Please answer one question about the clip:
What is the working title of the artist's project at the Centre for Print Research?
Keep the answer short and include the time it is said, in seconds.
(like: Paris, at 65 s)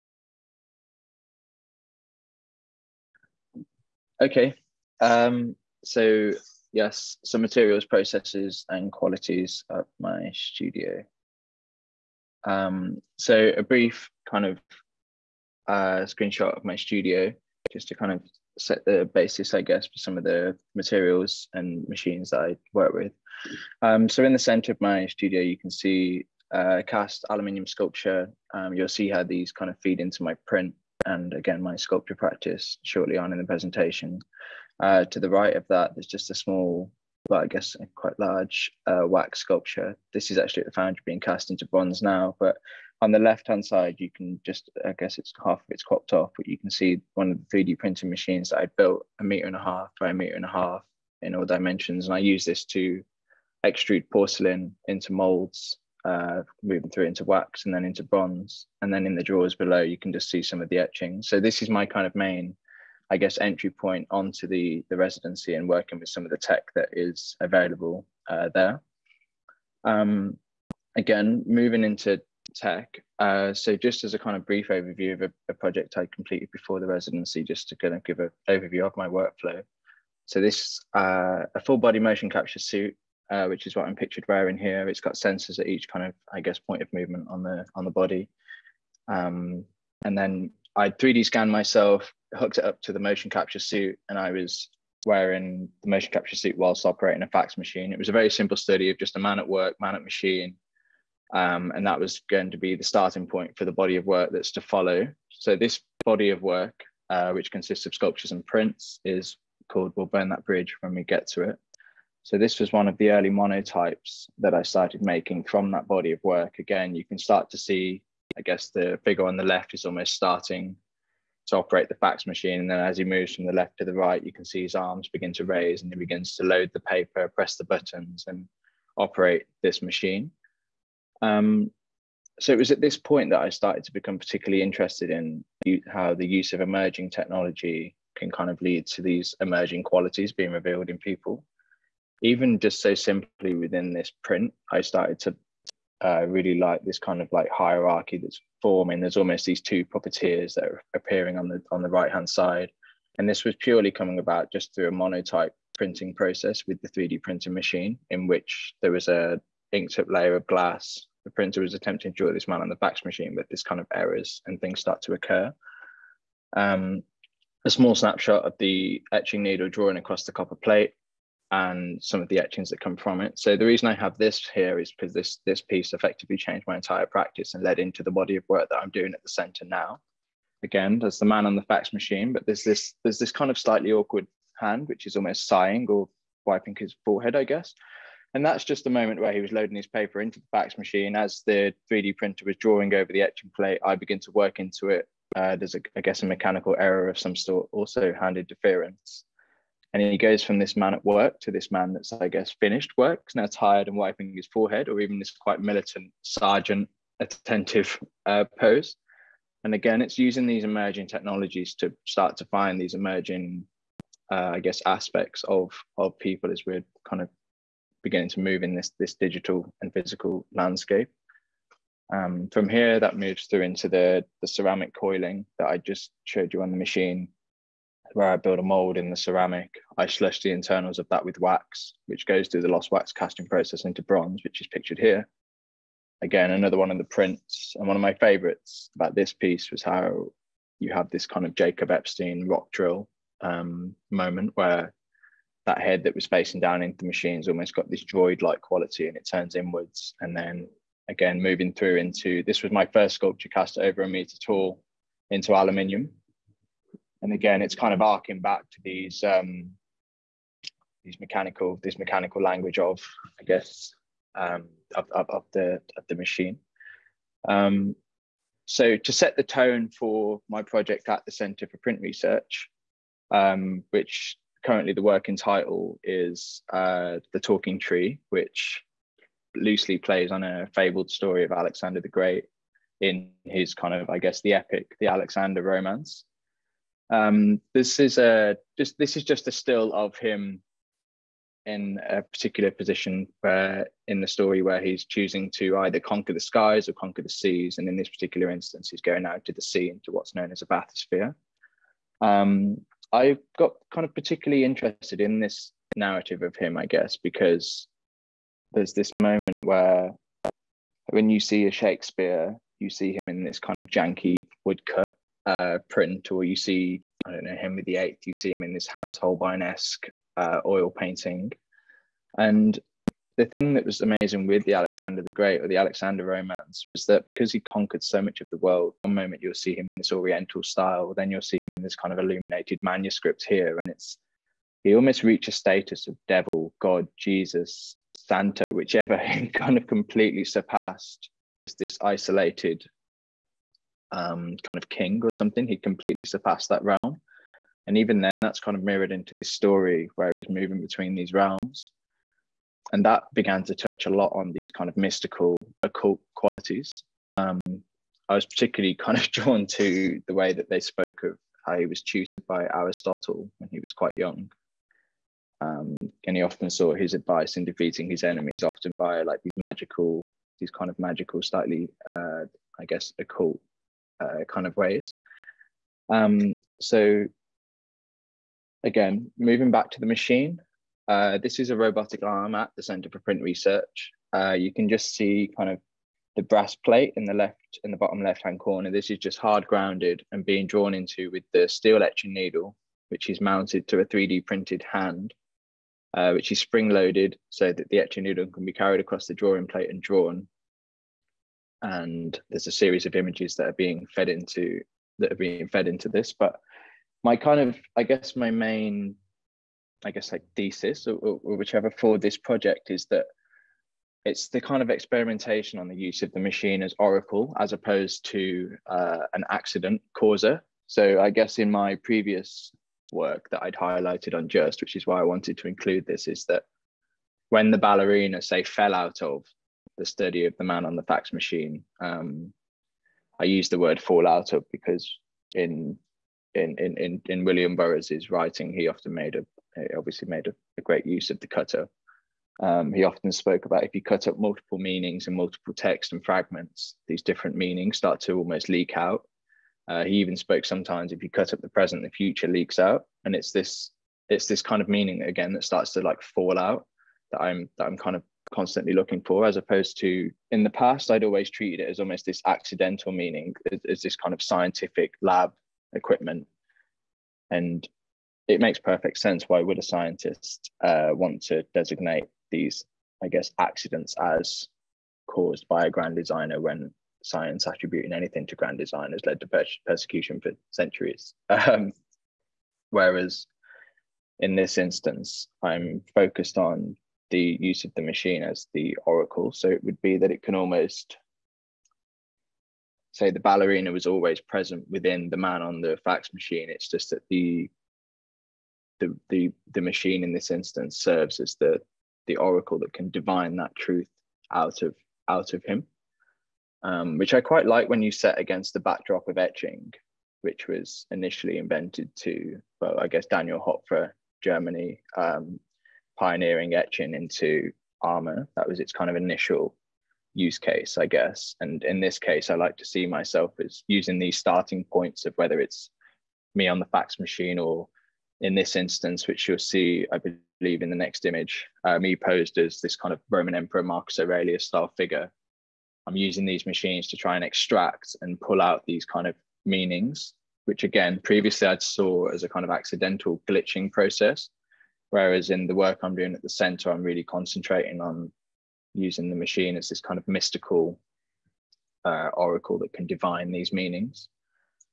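The Talking Tree, at 277 s.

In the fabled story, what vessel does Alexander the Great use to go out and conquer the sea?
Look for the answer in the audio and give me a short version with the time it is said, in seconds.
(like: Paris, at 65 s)
bathysphere, at 300 s.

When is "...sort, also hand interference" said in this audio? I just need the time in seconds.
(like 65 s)
197 s.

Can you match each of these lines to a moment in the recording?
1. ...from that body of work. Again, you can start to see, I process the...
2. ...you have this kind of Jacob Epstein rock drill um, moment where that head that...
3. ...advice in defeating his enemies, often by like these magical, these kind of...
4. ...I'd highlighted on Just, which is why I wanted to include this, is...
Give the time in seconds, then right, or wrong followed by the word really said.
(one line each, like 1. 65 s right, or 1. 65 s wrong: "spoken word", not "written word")
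1. 115 s wrong: "guess", not "process"
2. 240 s right
3. 367 s right
4. 423 s right.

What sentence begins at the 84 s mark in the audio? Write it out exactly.
It's got sensors at each kind of, I guess, point of movement on the on the body.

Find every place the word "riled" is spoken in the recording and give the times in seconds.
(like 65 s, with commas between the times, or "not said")
not said.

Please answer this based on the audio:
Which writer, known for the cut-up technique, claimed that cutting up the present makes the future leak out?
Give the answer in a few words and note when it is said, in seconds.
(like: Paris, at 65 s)
William Burroughs, at 437 s.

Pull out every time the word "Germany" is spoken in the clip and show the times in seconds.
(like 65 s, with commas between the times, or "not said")
514 s.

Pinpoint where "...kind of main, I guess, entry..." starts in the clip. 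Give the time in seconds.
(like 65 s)
61 s.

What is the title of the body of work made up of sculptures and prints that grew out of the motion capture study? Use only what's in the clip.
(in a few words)
We'll Burn That Bridge When We Get to It.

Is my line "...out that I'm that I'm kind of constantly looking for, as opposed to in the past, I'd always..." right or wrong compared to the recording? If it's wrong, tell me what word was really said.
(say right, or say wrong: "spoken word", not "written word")
right.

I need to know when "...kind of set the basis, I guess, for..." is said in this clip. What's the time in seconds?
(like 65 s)
17 s.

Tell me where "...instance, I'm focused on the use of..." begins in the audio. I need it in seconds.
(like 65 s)
484 s.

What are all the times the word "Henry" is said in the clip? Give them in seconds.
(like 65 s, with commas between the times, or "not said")
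317 s.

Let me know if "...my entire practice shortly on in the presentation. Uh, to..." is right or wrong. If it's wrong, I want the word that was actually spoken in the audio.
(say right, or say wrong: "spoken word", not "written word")
wrong: "sculpture", not "entire".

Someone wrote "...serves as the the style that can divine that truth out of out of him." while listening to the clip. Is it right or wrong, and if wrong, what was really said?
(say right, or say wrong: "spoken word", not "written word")
wrong: "oracle", not "style".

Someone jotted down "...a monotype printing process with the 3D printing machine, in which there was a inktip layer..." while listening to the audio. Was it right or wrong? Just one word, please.
right.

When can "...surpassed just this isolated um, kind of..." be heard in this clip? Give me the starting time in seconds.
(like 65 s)
340 s.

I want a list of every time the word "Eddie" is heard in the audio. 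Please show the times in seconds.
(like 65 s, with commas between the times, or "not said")
not said.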